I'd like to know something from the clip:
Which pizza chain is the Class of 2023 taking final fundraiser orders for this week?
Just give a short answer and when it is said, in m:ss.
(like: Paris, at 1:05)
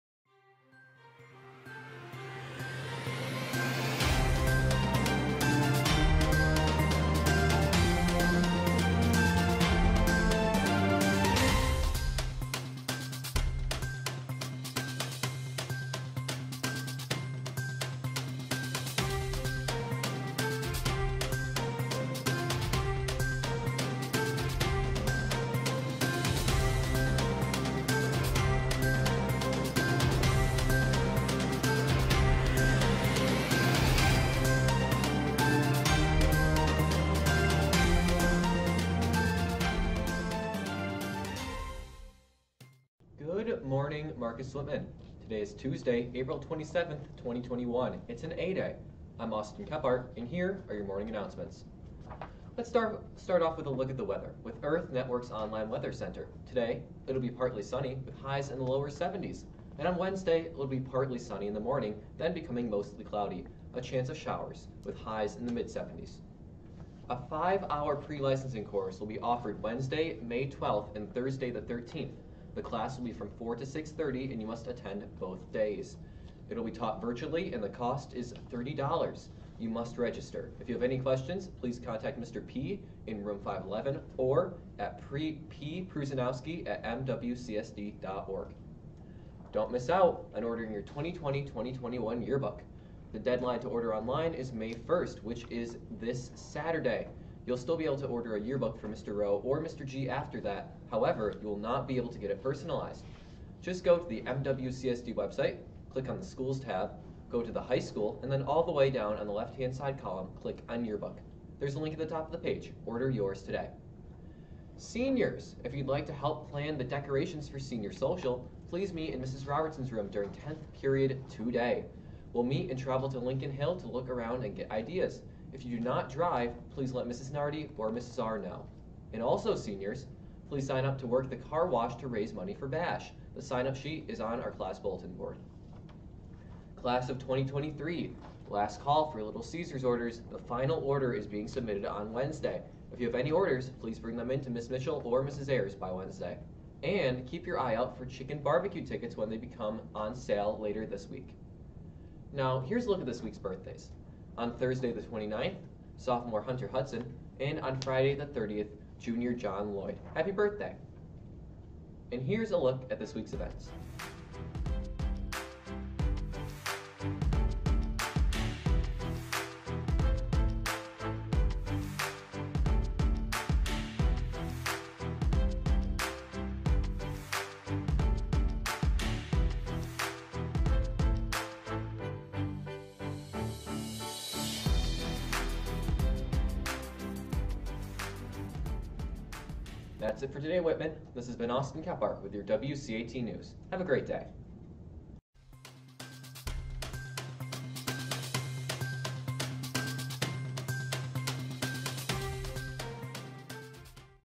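Little Caesars, at 2:19.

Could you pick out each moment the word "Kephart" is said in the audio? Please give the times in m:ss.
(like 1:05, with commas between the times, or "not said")
0:49, 3:11.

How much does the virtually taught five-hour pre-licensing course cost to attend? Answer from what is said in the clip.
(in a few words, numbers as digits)
$30.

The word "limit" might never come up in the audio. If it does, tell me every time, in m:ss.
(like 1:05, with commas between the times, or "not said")
not said.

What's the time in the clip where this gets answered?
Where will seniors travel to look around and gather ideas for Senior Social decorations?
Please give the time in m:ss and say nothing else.
2:03.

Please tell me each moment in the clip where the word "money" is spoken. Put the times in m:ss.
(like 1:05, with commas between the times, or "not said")
2:12.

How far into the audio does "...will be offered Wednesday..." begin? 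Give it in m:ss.
1:08.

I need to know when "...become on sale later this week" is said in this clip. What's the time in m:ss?
2:29.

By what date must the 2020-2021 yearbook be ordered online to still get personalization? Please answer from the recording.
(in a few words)
May 1st.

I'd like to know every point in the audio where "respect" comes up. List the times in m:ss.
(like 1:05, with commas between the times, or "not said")
not said.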